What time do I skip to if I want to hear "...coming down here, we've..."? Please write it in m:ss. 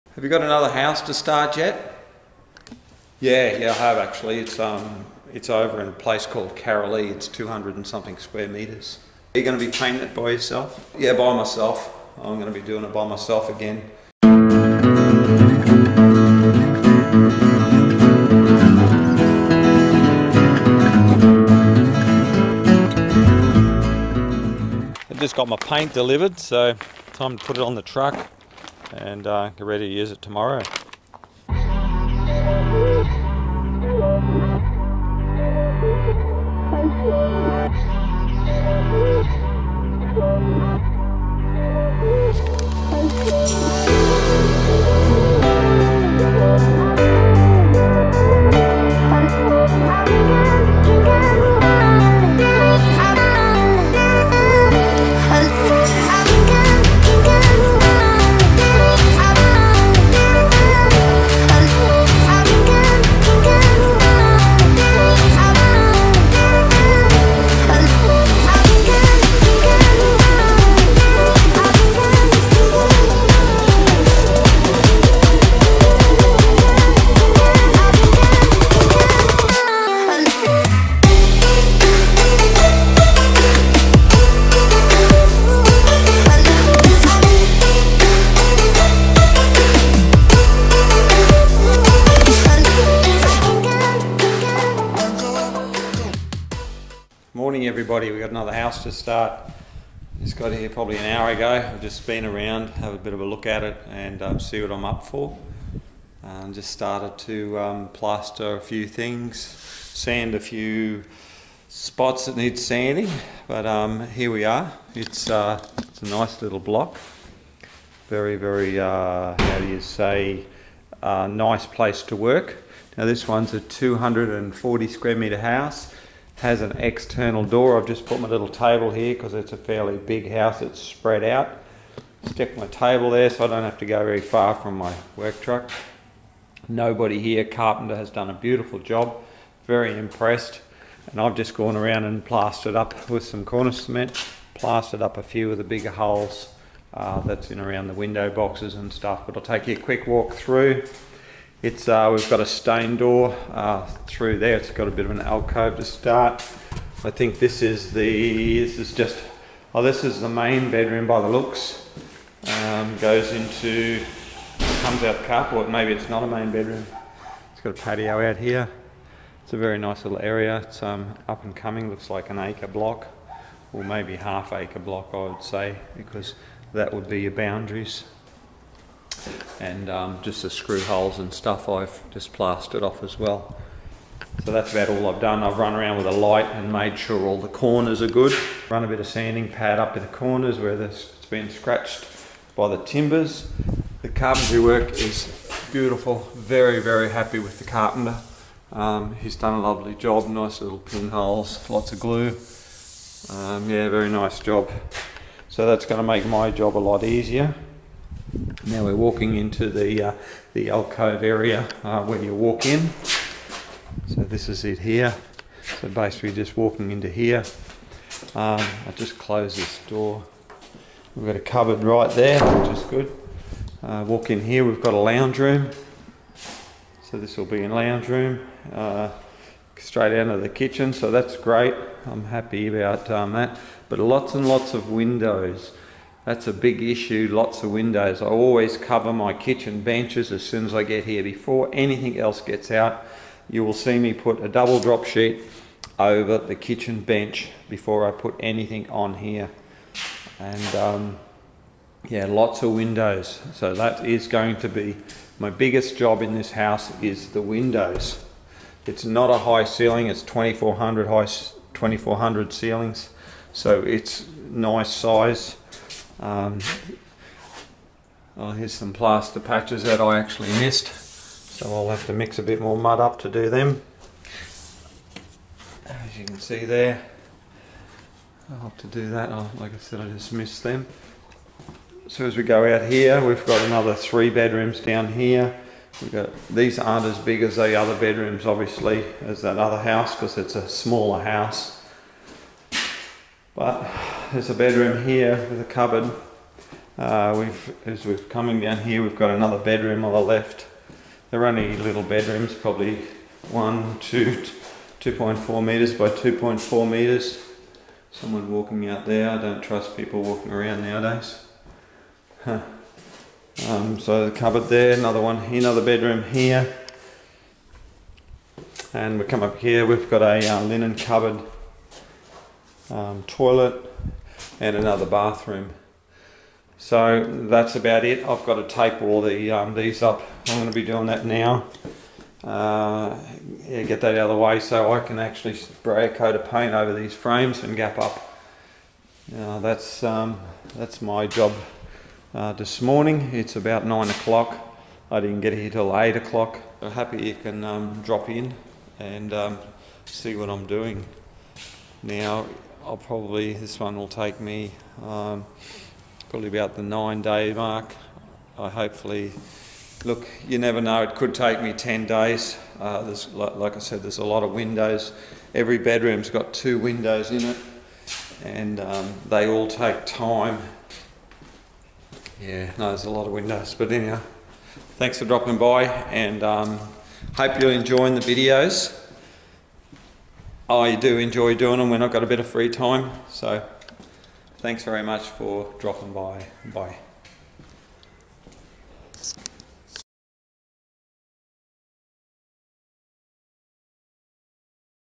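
4:58.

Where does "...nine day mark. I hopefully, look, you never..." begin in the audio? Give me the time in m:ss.
5:56.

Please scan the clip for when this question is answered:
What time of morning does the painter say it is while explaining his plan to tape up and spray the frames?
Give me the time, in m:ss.
5:43.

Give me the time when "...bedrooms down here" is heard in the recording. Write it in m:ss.
4:44.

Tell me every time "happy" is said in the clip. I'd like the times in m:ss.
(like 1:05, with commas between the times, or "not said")
3:17, 3:52, 5:46.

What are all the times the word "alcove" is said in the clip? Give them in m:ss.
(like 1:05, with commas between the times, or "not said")
2:35, 3:30.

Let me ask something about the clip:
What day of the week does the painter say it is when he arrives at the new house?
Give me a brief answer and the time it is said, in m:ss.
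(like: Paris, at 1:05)
Friday, at 1:38.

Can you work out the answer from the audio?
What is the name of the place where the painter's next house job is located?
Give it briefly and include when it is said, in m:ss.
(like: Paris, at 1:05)
Karalee, at 0:06.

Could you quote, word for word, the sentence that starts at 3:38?
Um, i just close this door.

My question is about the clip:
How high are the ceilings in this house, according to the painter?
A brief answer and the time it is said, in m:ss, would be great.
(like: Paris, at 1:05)
2400, at 4:21.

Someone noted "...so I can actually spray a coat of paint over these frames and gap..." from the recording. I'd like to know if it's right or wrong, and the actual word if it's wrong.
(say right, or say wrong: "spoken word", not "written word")
right.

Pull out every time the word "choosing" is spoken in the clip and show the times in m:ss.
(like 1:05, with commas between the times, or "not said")
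not said.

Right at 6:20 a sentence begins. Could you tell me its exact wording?
I do enjoy doing them when I've got a bit of free time.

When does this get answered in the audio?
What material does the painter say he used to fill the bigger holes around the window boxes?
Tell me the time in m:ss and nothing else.
2:23.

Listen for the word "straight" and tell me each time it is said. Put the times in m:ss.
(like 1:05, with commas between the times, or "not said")
3:49.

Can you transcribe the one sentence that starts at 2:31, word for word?
It's uh, We've got a stained door uh, through there.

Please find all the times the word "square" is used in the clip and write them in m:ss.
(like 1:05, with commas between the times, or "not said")
0:08, 2:04.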